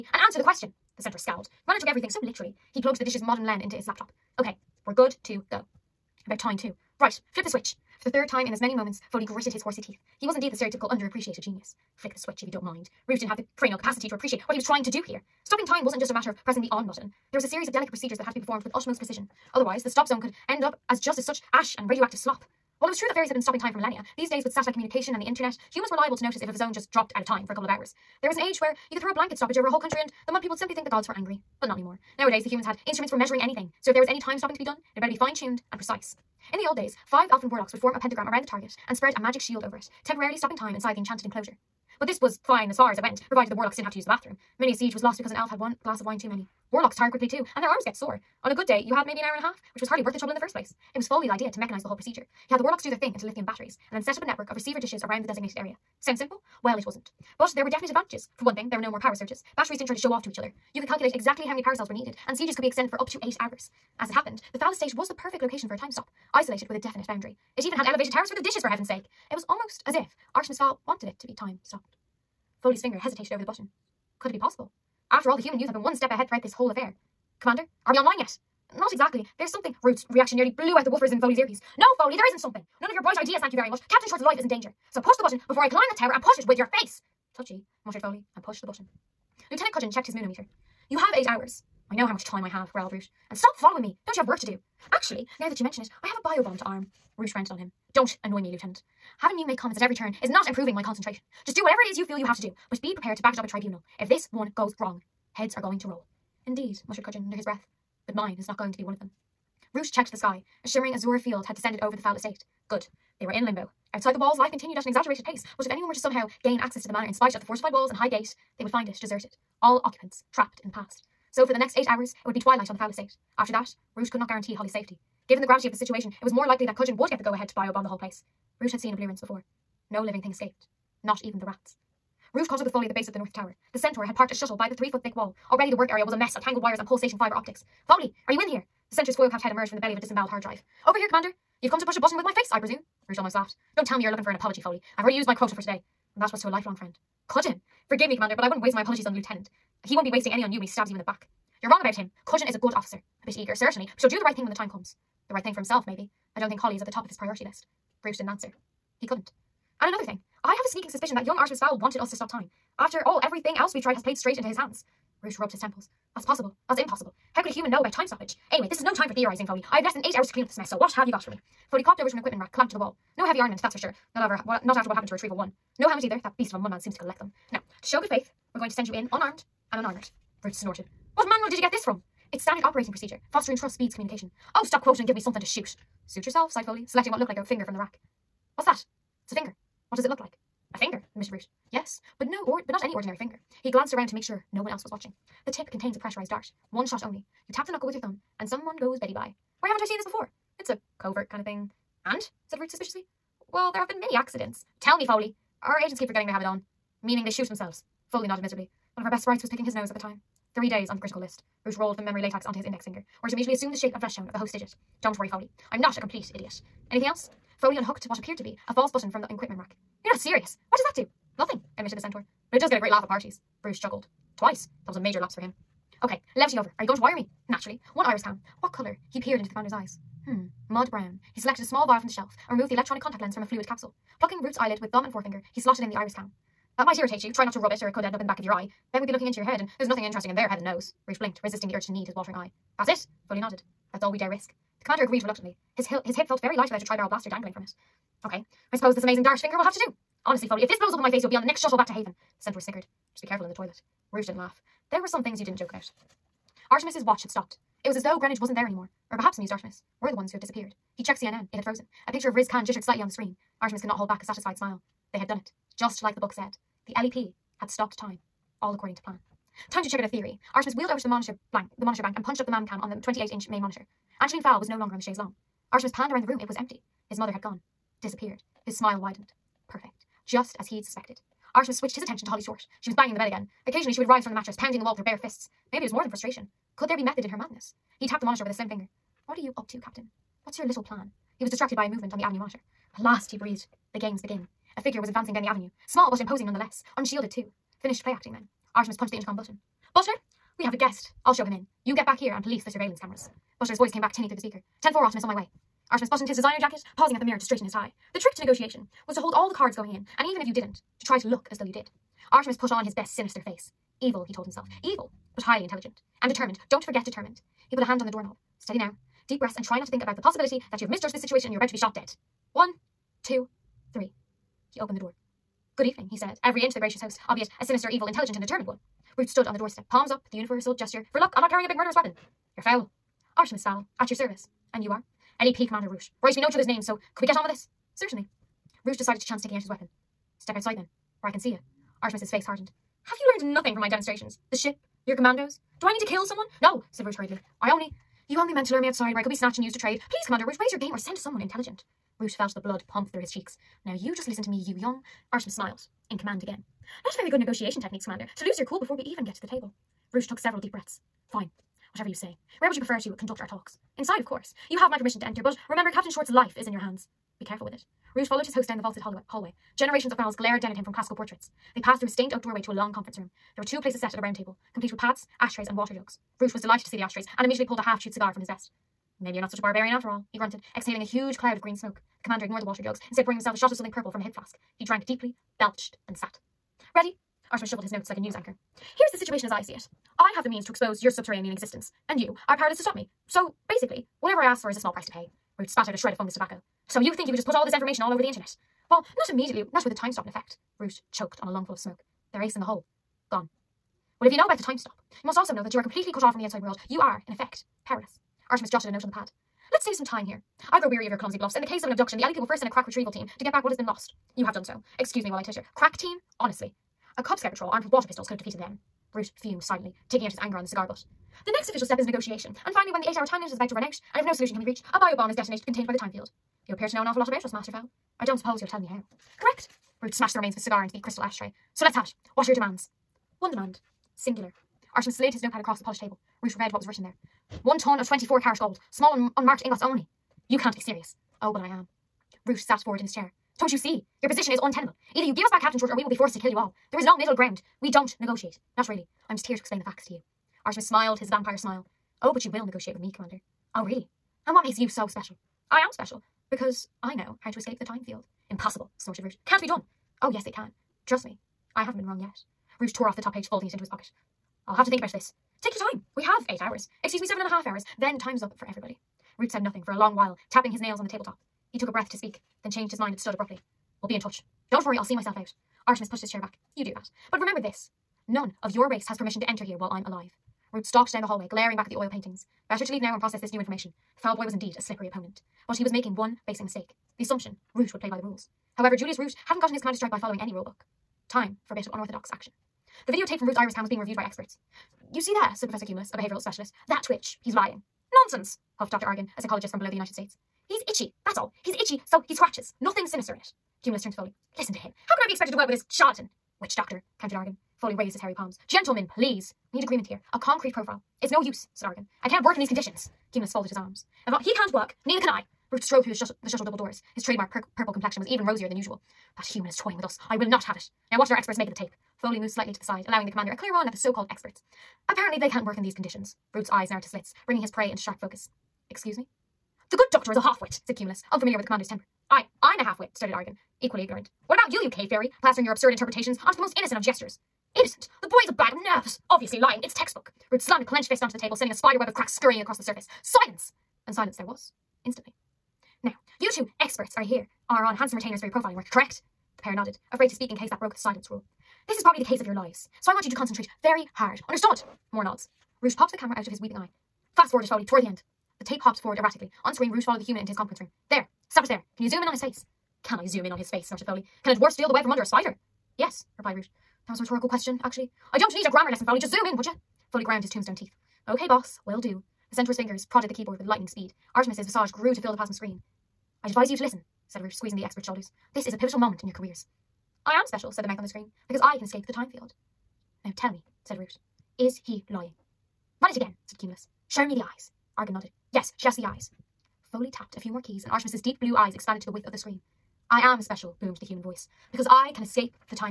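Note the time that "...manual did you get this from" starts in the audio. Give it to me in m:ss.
3:01.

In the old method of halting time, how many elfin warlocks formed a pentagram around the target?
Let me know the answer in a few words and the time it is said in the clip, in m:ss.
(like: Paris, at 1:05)
5, at 0:37.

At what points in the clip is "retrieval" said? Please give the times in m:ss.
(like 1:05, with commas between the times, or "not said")
2:55, 6:52.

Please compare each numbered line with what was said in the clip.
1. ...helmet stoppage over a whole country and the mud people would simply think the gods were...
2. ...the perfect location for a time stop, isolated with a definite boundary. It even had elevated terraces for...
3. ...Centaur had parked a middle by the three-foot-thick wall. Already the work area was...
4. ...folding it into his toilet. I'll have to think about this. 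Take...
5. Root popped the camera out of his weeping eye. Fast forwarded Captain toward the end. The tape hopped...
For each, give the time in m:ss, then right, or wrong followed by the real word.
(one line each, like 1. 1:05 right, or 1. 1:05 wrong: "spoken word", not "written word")
1. 0:29 wrong: "blanket", not "helmet"
2. 1:05 right
3. 2:13 wrong: "shuttle", not "middle"
4. 7:43 wrong: "pocket", not "toilet"
5. 9:15 wrong: "Foaly", not "Captain".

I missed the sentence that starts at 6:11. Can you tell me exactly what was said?
They passed through a stained oak doorway to a long conference room.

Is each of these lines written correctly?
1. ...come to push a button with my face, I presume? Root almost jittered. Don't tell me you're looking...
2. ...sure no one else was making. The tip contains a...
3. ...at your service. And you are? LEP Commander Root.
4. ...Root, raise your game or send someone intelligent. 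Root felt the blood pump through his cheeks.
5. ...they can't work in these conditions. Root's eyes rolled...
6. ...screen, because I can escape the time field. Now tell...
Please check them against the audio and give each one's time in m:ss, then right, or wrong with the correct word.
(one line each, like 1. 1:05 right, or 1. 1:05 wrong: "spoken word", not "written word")
1. 2:21 wrong: "laughed", not "jittered"
2. 3:14 wrong: "watching", not "making"
3. 5:33 right
4. 5:50 right
5. 8:45 wrong: "narrowed", not "rolled"
6. 9:41 right.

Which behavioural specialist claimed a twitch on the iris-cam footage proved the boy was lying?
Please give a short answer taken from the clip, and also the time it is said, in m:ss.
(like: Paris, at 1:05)
Professor Cumulus, at 8:15.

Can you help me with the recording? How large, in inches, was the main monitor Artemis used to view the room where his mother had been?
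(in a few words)
28.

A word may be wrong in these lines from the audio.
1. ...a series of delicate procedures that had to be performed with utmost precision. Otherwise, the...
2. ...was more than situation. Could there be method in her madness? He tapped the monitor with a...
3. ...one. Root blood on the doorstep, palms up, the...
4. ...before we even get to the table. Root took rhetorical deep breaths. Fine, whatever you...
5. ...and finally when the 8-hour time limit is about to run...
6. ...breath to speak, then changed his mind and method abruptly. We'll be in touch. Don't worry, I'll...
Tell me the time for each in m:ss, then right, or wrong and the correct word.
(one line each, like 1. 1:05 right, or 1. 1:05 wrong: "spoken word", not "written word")
1. 0:17 right
2. 4:45 wrong: "frustration", not "situation"
3. 5:28 wrong: "stood", not "blood"
4. 5:58 wrong: "several", not "rhetorical"
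5. 7:02 right
6. 7:51 wrong: "stood", not "method".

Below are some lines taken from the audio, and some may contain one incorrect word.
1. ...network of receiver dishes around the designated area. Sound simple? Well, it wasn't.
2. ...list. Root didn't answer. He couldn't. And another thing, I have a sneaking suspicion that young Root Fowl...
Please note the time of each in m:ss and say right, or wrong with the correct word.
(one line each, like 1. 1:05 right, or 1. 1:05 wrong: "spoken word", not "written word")
1. 0:54 right
2. 2:37 wrong: "Artemis", not "Root".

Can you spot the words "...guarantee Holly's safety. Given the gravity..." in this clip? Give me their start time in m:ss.
2:04.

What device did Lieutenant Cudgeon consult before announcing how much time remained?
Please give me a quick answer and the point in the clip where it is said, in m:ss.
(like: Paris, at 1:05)
Moonometer, at 1:30.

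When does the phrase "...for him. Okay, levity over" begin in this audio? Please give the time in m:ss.
3:45.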